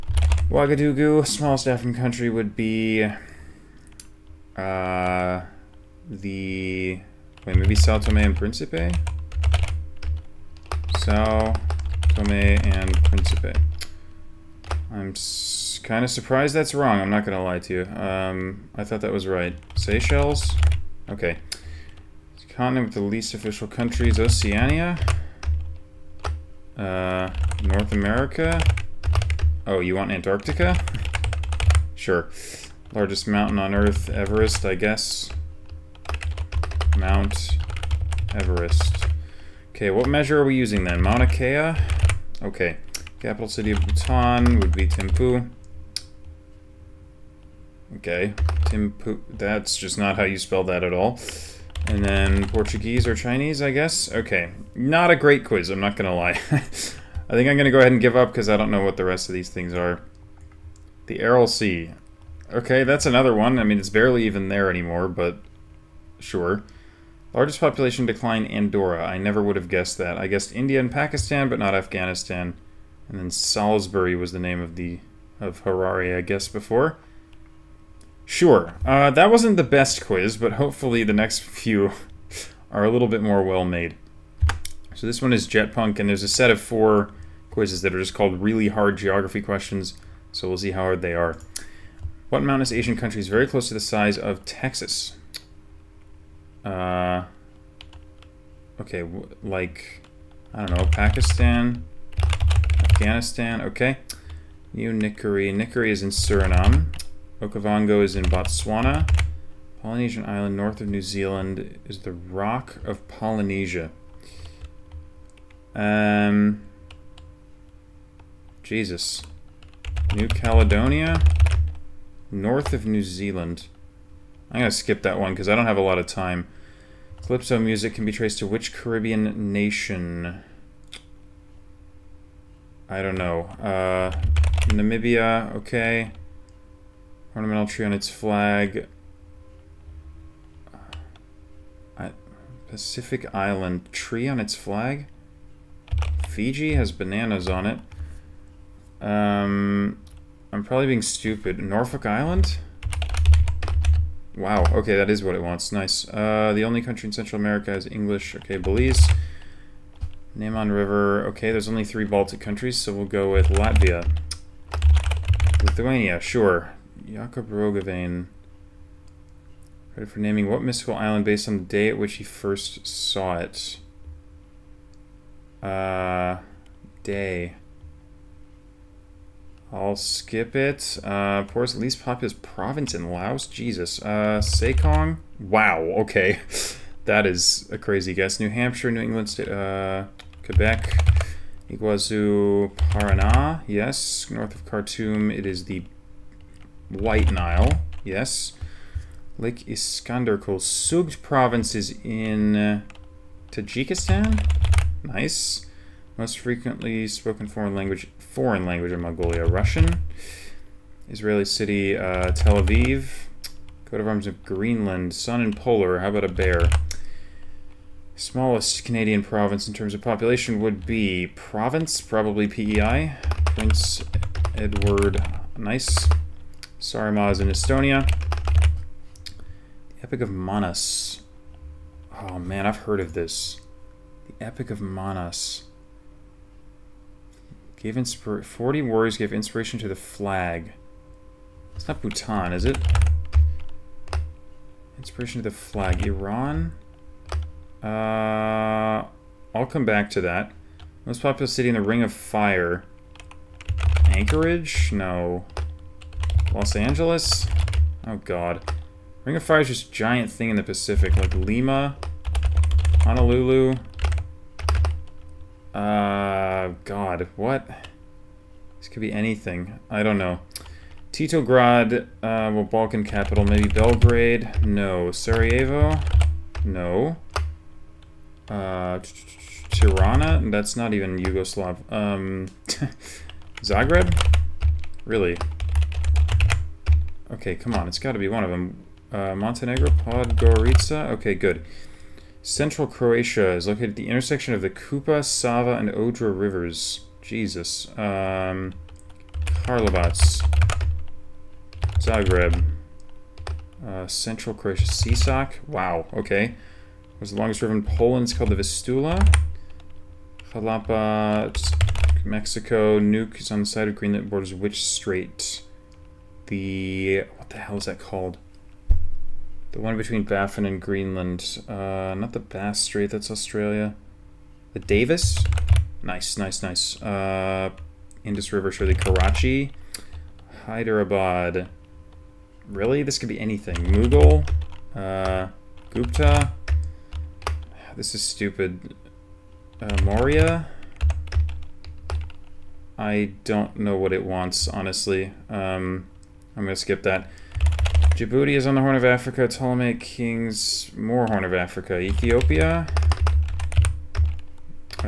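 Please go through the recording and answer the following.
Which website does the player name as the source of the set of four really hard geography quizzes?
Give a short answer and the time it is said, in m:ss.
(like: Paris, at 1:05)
Jetpunk, at 1:25.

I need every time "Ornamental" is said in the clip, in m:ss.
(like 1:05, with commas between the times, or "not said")
2:17.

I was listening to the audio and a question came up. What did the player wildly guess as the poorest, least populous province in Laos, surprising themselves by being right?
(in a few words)
Sekong.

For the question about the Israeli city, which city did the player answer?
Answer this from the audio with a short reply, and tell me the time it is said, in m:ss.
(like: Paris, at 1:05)
Tel Aviv, at 3:32.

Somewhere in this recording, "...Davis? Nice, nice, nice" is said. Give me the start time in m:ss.
5:24.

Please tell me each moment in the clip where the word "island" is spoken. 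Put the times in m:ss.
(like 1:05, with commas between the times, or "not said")
1:50, 2:23, 2:32, 2:50.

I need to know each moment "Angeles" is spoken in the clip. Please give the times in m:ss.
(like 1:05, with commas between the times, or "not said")
4:16.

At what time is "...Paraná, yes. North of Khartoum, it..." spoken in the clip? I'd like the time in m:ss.
3:12.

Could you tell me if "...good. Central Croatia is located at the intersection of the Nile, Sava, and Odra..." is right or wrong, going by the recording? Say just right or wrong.
wrong.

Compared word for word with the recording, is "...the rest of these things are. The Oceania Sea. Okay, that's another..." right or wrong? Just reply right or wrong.
wrong.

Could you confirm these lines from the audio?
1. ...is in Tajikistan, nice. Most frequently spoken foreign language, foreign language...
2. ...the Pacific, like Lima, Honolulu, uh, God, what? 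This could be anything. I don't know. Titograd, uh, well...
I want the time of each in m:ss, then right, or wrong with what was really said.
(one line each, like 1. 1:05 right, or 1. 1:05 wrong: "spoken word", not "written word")
1. 3:21 right
2. 4:20 right.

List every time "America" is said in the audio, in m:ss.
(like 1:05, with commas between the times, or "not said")
0:27, 2:37.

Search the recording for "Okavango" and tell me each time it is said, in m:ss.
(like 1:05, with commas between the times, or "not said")
1:47.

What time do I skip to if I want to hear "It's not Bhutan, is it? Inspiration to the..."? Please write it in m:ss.
4:01.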